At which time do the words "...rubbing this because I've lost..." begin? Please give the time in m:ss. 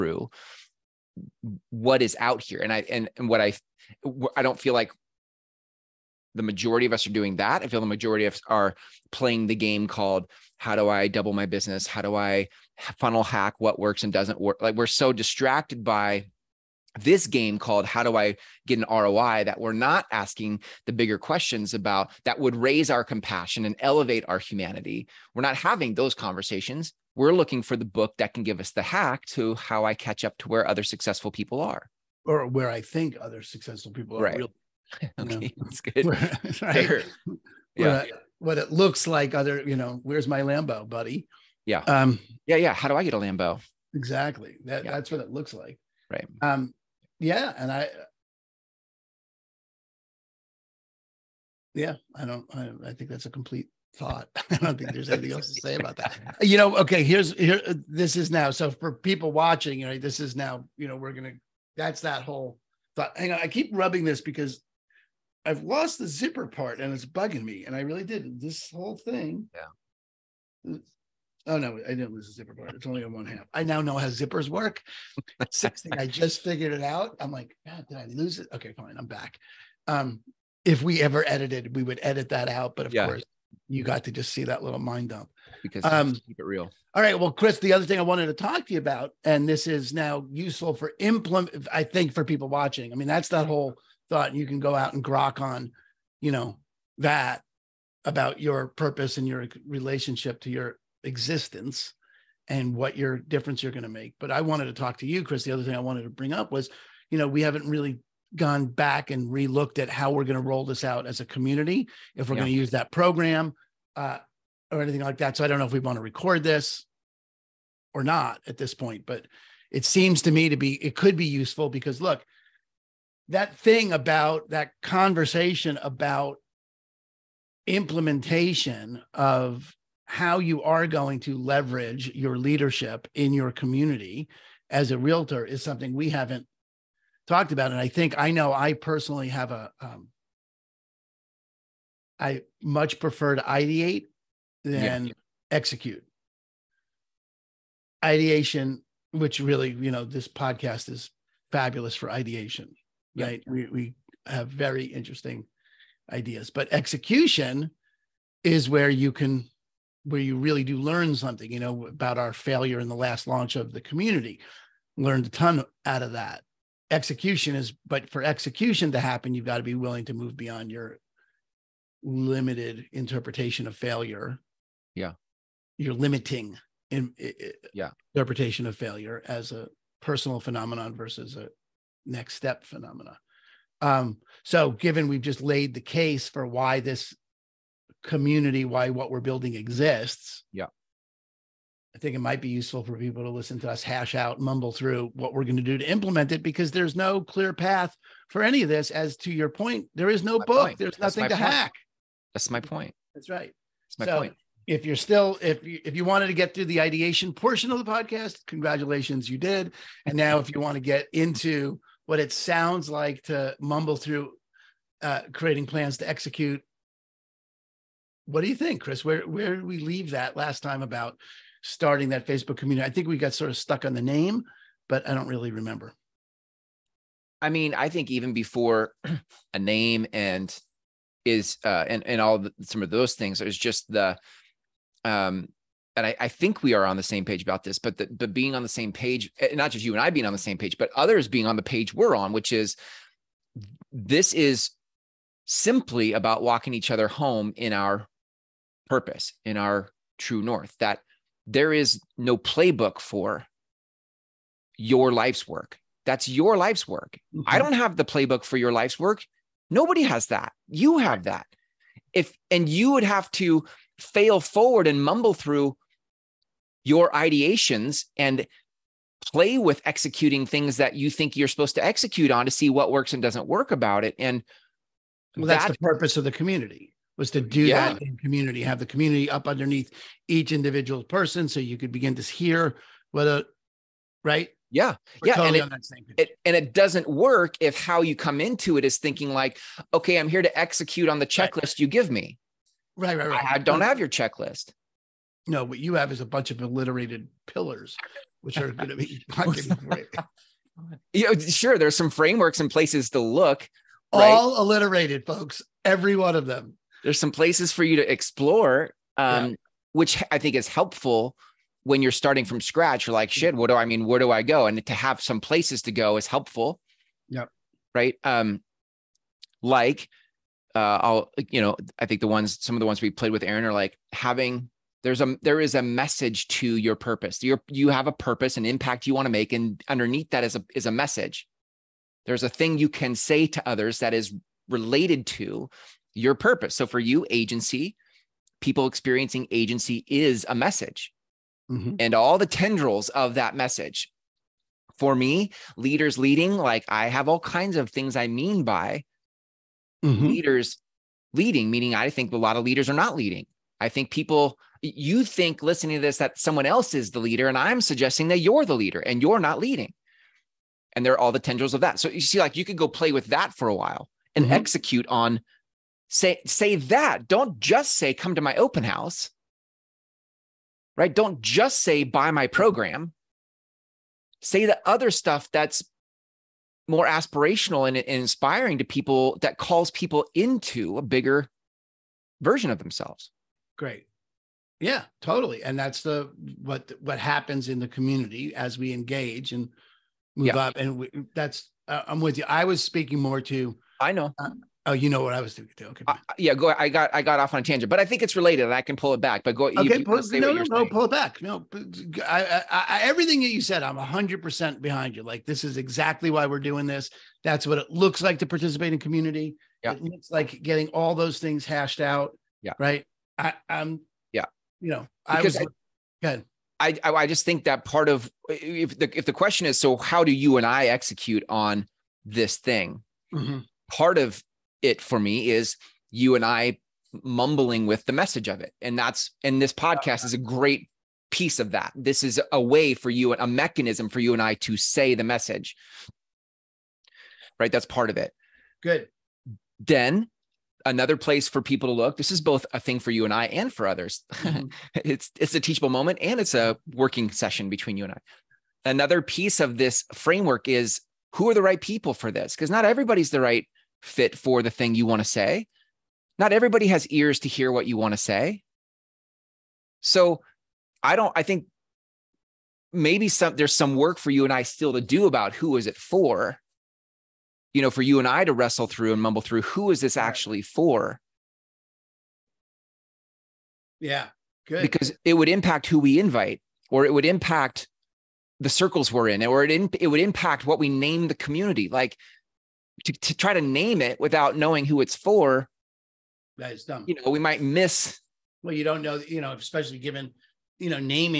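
1:03.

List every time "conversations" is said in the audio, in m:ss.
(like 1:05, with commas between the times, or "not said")
0:26, 2:04.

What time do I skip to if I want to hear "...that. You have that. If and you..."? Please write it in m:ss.
4:20.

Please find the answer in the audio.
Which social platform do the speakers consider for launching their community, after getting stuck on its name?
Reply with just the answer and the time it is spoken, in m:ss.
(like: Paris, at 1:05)
Facebook, at 3:41.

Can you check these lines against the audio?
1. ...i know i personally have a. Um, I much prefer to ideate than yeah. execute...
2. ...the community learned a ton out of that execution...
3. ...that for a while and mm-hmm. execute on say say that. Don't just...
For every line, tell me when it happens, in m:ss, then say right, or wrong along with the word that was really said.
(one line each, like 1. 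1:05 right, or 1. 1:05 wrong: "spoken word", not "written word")
1. 2:18 right
2. 2:43 right
3. 6:03 right.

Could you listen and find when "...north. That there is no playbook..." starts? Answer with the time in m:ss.
4:10.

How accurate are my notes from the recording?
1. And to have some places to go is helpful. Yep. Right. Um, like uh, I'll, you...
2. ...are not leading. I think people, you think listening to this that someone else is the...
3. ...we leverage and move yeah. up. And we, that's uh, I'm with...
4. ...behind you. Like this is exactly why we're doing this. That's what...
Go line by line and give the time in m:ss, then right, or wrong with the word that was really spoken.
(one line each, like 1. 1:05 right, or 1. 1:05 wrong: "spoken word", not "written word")
1. 5:14 right
2. 5:52 right
3. 6:28 wrong: "engage", not "leverage"
4. 6:44 right.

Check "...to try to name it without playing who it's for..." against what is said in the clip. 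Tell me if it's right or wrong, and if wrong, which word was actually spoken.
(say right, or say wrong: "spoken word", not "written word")
wrong: "knowing", not "playing".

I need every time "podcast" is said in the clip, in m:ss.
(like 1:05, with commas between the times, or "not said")
2:30, 3:27, 7:09.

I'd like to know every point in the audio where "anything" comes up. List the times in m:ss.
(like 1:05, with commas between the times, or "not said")
0:55, 1:54.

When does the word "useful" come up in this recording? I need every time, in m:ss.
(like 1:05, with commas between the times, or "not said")
1:30, 2:01, 3:12.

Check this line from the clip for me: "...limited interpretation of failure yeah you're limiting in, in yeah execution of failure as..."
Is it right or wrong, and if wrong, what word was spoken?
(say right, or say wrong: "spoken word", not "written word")
wrong: "interpretation", not "execution".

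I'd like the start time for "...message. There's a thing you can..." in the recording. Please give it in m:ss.
5:30.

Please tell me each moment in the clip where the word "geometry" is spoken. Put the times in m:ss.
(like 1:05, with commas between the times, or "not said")
not said.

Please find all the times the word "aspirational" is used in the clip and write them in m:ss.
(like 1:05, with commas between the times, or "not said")
6:17.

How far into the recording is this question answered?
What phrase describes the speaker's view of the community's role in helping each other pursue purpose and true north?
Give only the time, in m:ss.
4:06.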